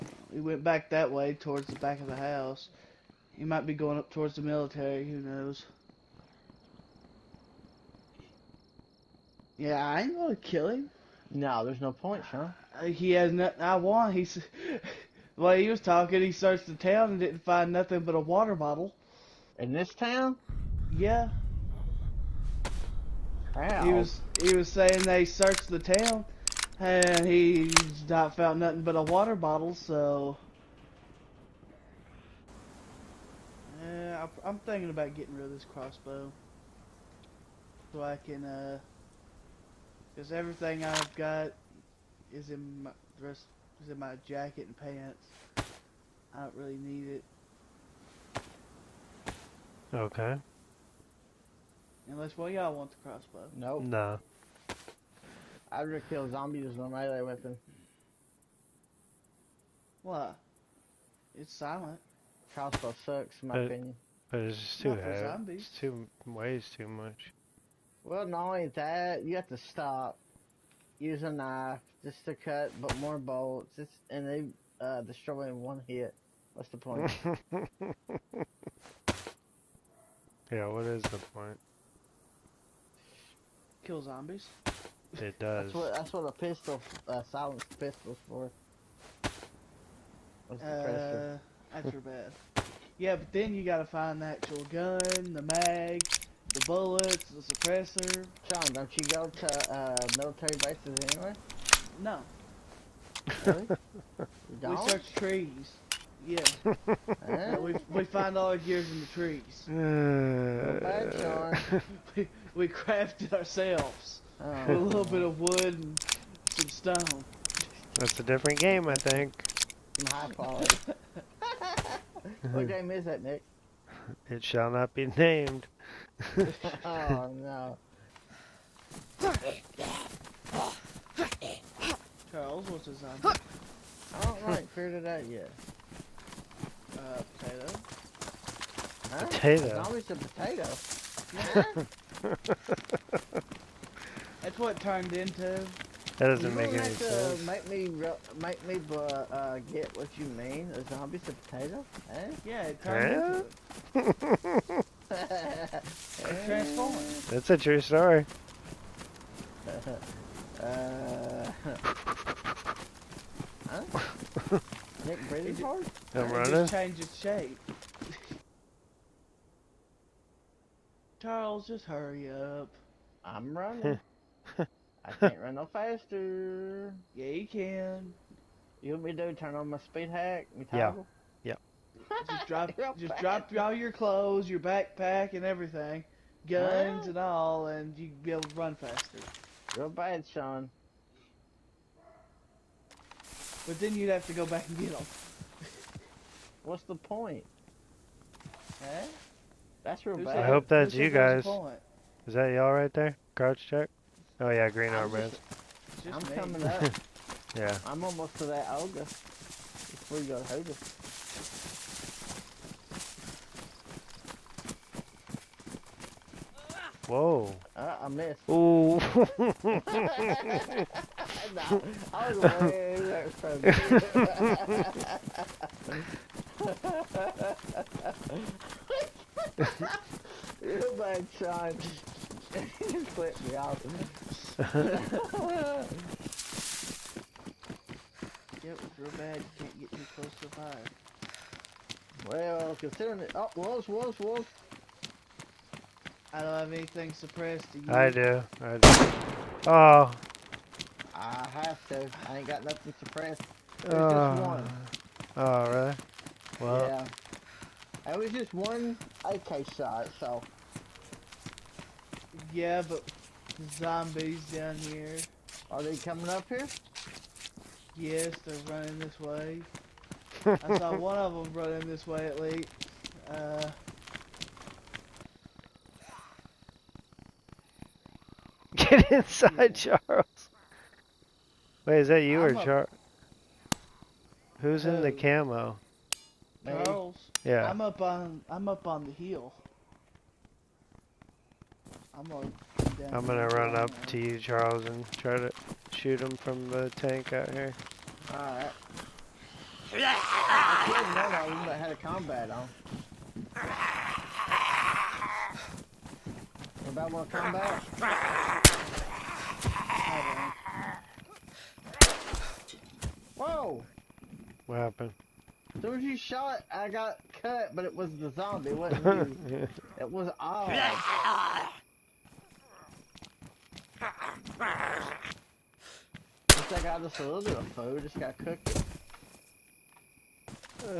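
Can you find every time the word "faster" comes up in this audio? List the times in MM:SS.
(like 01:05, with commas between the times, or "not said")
02:55, 03:08.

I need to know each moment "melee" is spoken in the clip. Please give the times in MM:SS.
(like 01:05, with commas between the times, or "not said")
00:56.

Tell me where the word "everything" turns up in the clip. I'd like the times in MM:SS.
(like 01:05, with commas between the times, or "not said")
00:40, 03:05.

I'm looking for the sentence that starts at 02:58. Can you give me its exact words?
You want me to turn on my speed hack?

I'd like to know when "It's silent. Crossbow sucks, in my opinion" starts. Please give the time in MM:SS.
01:01.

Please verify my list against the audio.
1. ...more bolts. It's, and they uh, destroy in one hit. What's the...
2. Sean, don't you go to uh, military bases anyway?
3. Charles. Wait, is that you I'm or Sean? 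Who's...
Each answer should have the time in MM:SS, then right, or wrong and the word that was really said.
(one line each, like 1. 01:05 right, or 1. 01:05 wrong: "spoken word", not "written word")
1. 01:12 right
2. 01:38 right
3. 04:40 wrong: "Charles", not "Sean".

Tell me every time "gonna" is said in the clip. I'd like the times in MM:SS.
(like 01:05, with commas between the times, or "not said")
00:10, 04:53.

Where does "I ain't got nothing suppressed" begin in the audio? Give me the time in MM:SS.
04:12.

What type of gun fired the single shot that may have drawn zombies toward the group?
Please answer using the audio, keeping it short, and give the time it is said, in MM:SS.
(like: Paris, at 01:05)
AK, at 04:19.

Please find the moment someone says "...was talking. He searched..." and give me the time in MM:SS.
00:15.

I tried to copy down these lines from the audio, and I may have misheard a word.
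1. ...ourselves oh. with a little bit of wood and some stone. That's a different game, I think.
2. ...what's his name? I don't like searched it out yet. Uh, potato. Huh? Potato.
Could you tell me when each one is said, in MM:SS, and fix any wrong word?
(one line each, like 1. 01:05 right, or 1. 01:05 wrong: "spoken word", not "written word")
1. 01:53 right
2. 02:12 wrong: "figured", not "searched".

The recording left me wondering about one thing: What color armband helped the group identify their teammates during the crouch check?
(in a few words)
green.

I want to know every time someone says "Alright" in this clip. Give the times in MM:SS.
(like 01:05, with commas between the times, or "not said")
04:58.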